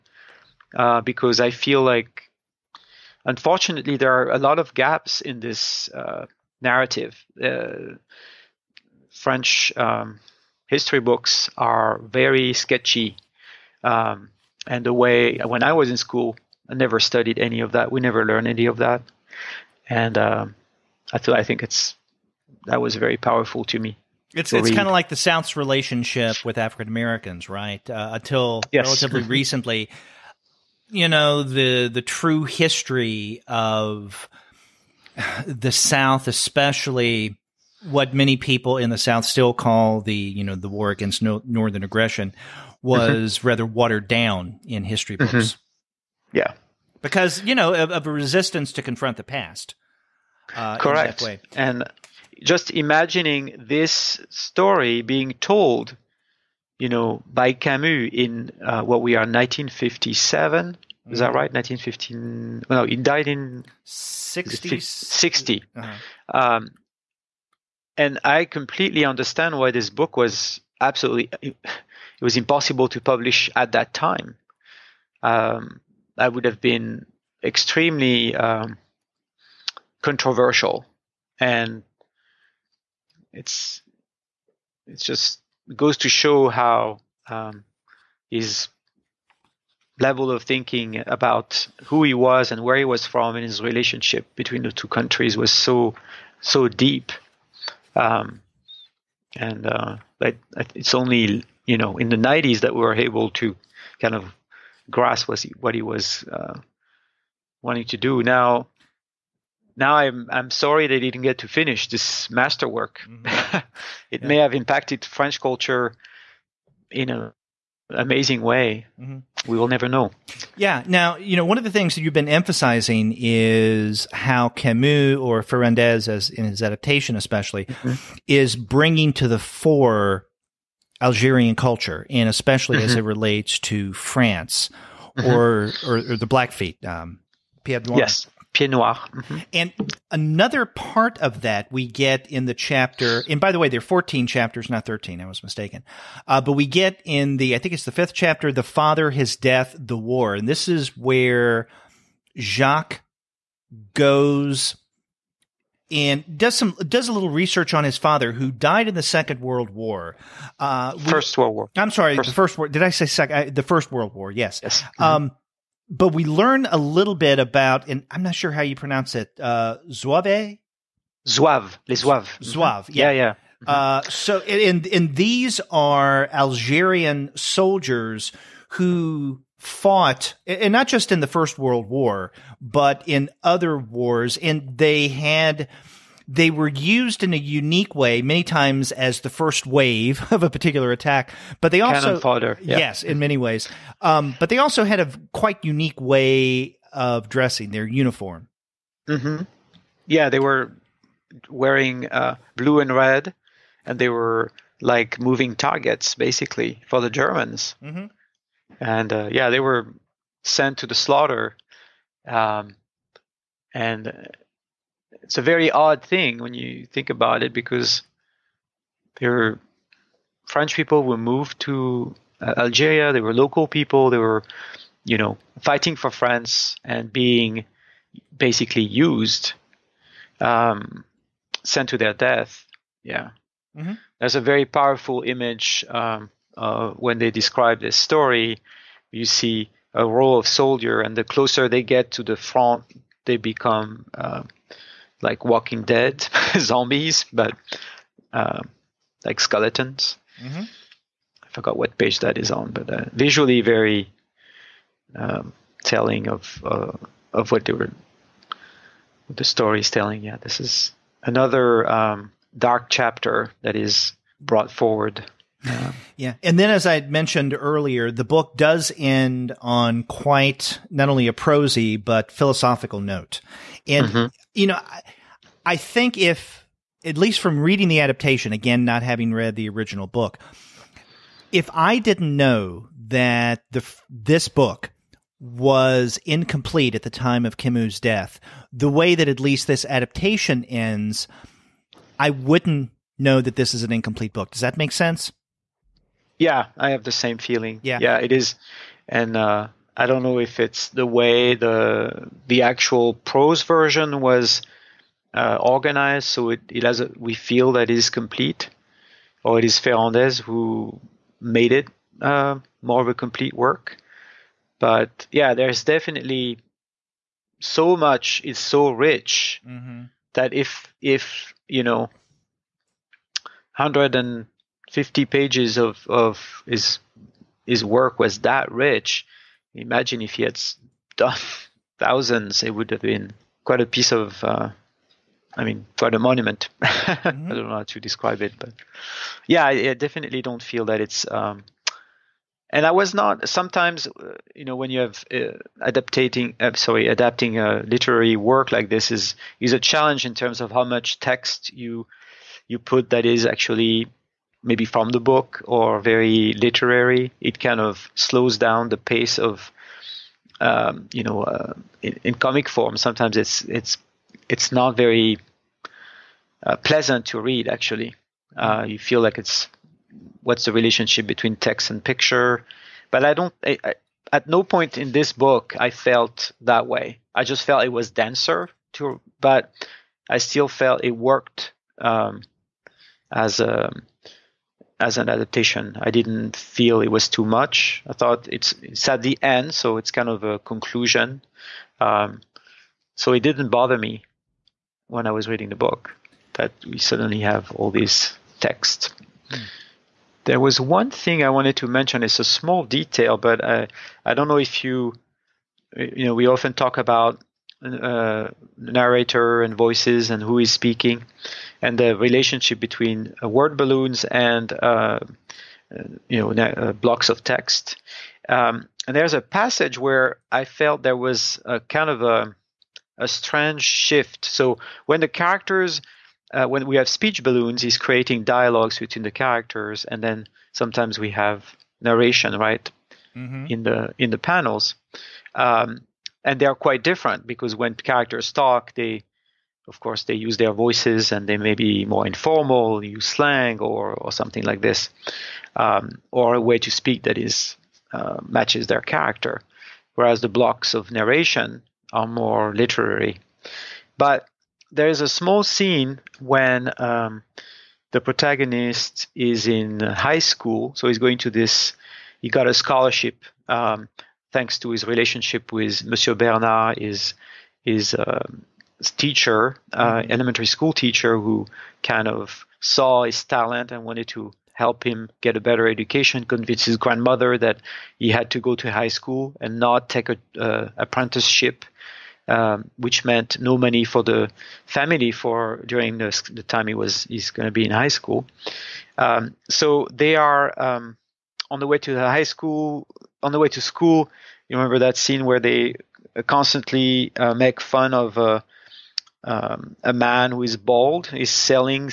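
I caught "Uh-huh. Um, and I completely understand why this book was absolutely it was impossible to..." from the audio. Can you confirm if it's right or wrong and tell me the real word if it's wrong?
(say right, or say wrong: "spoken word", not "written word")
right.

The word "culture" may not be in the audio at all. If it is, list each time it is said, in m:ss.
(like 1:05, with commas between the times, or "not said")
1:55, 2:11.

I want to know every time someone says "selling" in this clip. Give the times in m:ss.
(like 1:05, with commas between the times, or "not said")
8:21.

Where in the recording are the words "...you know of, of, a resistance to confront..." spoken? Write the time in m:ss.
0:47.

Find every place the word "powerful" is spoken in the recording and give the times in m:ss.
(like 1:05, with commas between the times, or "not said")
0:23, 3:54.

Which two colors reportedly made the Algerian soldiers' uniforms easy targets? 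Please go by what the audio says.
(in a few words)
Blue and red.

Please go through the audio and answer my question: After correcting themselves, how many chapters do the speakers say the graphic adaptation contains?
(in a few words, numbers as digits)
14.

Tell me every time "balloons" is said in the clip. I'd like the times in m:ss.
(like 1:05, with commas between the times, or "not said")
6:53, 7:07.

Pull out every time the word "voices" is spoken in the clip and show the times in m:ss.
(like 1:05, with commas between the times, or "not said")
6:49, 7:20.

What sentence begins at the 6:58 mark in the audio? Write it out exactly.
Um, and there's a passage where I felt there was a kind of a, a strange shift.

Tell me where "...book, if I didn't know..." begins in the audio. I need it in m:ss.
4:40.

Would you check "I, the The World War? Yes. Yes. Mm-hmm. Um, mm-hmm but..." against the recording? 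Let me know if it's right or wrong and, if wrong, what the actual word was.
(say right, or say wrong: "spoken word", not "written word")
wrong: "First", not "The".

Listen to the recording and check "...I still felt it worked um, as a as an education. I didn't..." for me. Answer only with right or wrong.
wrong.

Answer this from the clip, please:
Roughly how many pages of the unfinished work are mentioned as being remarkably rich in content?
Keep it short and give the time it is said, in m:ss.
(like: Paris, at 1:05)
150, at 5:23.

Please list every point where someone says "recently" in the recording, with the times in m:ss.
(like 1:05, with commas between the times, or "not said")
0:29.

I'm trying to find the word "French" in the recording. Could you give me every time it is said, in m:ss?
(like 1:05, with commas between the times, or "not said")
0:09, 1:55, 3:40.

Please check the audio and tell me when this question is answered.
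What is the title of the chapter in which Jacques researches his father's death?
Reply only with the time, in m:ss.
2:28.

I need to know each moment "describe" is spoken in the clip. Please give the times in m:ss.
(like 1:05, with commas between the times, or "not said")
3:57, 5:38.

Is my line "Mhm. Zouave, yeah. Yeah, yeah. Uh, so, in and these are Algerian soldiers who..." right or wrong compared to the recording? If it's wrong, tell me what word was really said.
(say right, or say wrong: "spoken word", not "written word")
right.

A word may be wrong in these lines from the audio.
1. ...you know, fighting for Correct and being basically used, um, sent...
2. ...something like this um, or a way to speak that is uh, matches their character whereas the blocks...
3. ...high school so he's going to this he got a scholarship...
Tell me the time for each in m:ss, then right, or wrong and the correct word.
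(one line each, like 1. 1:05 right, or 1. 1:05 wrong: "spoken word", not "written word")
1. 3:45 wrong: "France", not "Correct"
2. 7:24 right
3. 7:39 right.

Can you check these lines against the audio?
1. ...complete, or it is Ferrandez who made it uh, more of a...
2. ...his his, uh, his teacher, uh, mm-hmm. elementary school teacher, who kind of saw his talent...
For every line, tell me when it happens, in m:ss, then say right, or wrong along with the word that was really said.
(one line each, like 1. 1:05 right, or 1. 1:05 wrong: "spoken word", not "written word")
1. 5:08 right
2. 7:46 right.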